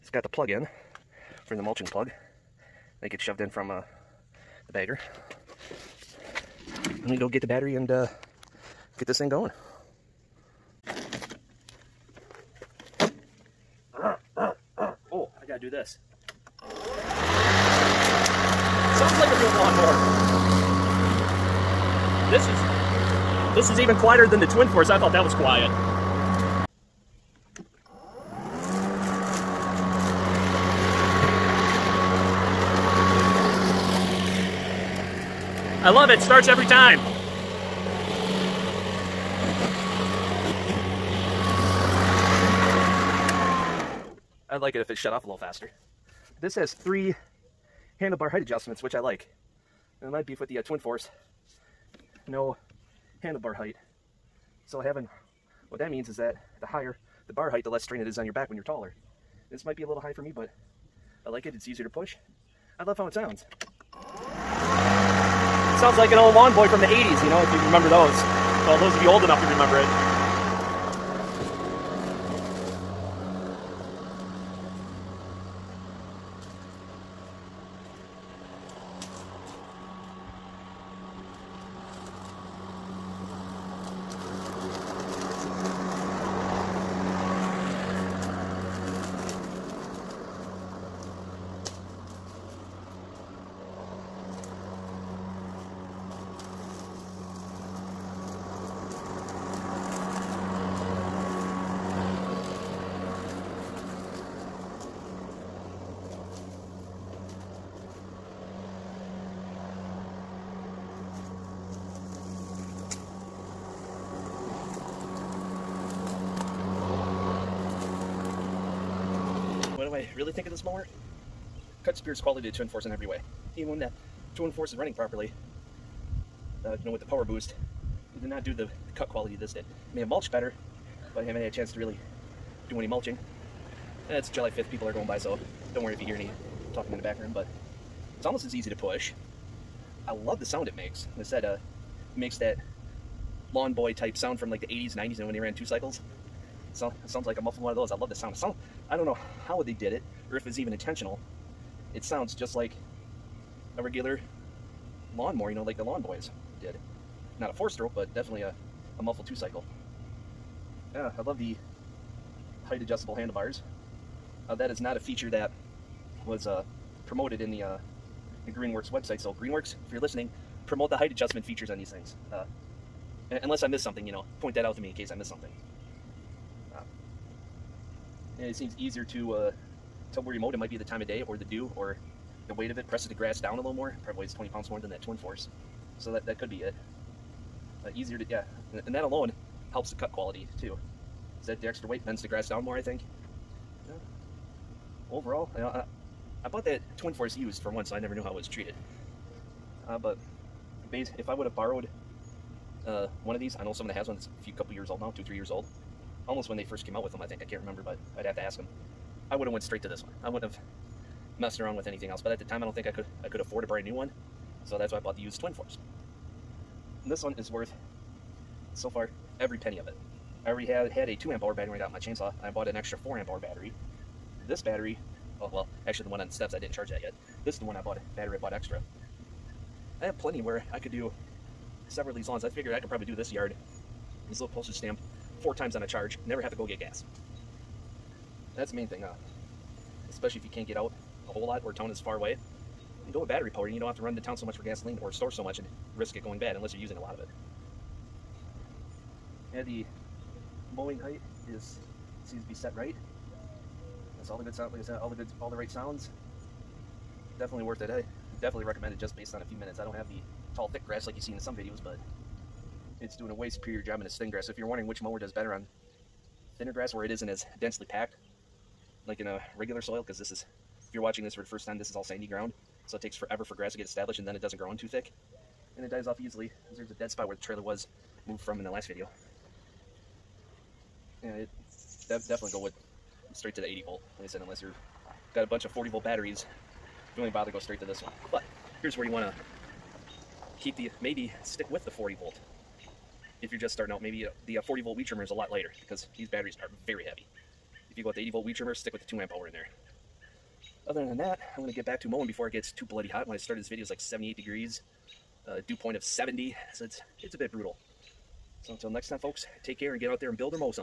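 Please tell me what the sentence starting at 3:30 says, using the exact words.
I wouldn't have messed around with anything else.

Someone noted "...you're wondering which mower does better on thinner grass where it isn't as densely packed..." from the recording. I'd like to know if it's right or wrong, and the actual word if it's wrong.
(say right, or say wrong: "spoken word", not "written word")
right.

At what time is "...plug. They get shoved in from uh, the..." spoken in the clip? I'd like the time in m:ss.
0:01.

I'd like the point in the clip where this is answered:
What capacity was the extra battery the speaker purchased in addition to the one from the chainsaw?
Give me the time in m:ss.
3:42.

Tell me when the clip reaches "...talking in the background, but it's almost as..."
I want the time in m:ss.
2:16.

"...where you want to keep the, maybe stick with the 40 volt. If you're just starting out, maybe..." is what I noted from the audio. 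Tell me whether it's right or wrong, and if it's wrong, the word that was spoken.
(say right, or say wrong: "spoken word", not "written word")
right.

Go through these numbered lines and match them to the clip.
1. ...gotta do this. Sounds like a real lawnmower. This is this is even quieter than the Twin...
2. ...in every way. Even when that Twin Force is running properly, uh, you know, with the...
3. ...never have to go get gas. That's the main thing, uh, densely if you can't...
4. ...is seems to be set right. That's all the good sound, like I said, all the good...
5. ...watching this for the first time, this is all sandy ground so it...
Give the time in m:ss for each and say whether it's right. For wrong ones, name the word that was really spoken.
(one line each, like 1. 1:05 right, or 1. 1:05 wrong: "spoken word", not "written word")
1. 0:15 right
2. 2:02 right
3. 3:56 wrong: "especially", not "densely"
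4. 4:11 right
5. 4:31 right.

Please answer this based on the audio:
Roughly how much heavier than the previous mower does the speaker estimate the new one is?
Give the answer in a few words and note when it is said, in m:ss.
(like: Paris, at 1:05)
20 pounds, at 3:04.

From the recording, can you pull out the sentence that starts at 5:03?
When I started this video, it's like 78 degrees, uh, dew point of 70, so it's, it's a bit brutal.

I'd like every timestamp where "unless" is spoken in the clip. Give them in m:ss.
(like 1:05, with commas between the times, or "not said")
2:53, 4:06, 4:44.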